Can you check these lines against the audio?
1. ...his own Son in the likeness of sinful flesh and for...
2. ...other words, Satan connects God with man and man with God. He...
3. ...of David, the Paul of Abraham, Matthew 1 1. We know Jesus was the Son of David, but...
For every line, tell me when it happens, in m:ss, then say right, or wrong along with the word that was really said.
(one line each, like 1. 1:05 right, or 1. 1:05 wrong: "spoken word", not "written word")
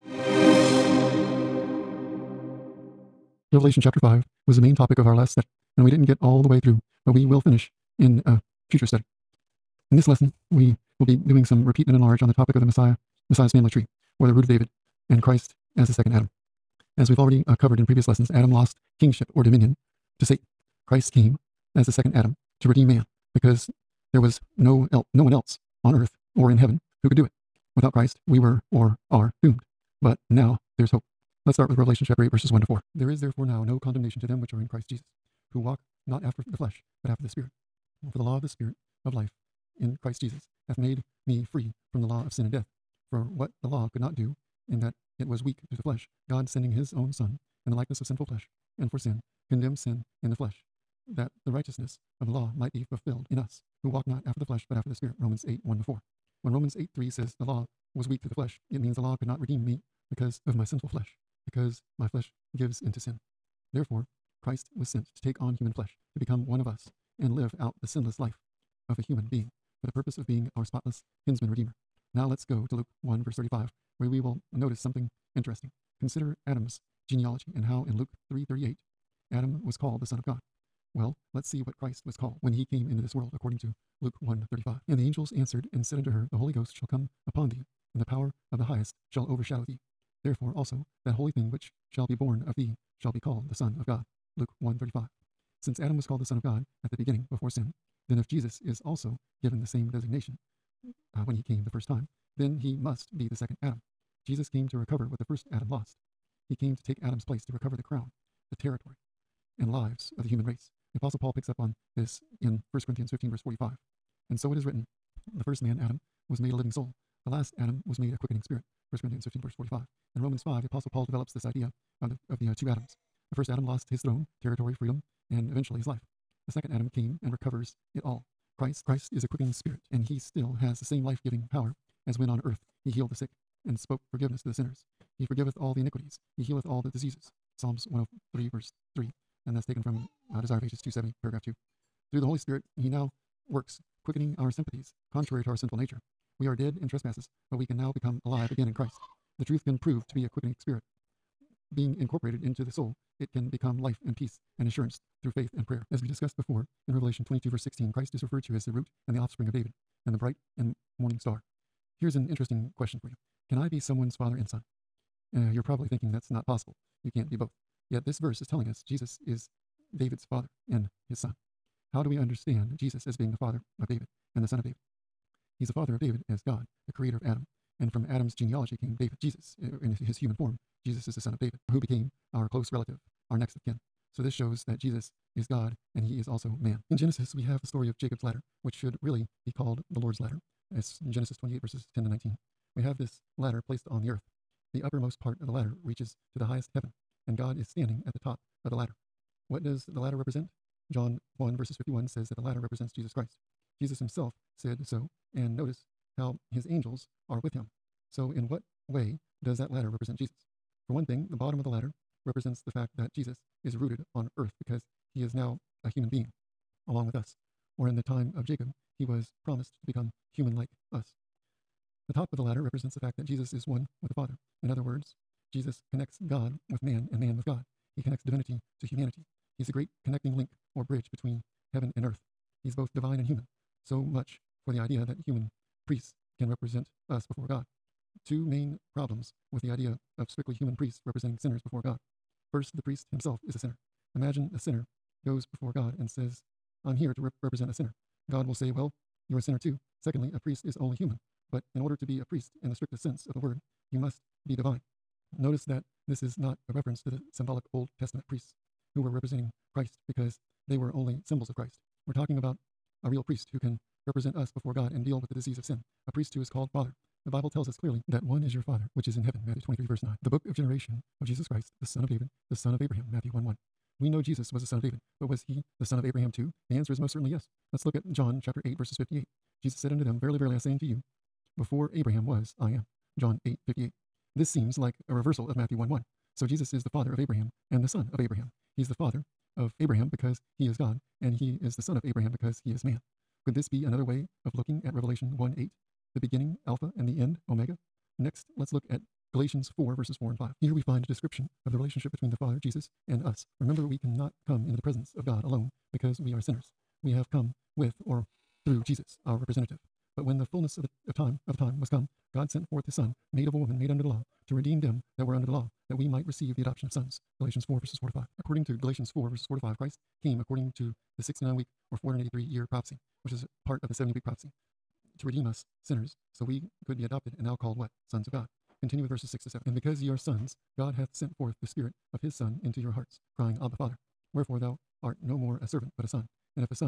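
1. 0:46 right
2. 3:44 wrong: "Jesus", not "Satan"
3. 4:32 wrong: "Son", not "Paul".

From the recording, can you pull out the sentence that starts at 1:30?
Therefore also that holy thing which shall be born of thee shall be called the Son of God.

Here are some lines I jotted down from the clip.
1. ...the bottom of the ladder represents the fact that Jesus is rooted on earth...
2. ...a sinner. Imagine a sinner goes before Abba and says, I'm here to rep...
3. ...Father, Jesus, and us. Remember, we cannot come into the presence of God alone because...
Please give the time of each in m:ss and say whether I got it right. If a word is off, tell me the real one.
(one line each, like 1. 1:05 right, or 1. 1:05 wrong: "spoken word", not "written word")
1. 3:31 right
2. 4:03 wrong: "God", not "Abba"
3. 5:02 right.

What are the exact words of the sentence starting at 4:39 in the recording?
Jesus said unto them, Verily, verily, I say unto you, before Abraham was, I am.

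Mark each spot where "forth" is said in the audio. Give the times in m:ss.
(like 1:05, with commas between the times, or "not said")
5:12, 5:31.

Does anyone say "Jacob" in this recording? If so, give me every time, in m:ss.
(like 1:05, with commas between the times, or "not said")
3:07, 3:38.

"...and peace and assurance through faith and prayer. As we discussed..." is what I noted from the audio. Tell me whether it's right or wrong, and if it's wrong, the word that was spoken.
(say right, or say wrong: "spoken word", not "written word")
right.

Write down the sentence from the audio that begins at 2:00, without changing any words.
In Romans 5, the Apostle Paul develops this idea of the, of the uh, two Adams.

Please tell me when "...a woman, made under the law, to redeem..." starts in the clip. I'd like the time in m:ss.
5:13.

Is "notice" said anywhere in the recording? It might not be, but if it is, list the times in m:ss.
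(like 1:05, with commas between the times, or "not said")
1:14, 3:25, 4:15.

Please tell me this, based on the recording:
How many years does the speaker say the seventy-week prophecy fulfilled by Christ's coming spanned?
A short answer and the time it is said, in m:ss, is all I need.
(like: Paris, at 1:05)
483, at 5:21.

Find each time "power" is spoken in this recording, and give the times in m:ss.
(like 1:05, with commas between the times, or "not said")
1:28, 2:11.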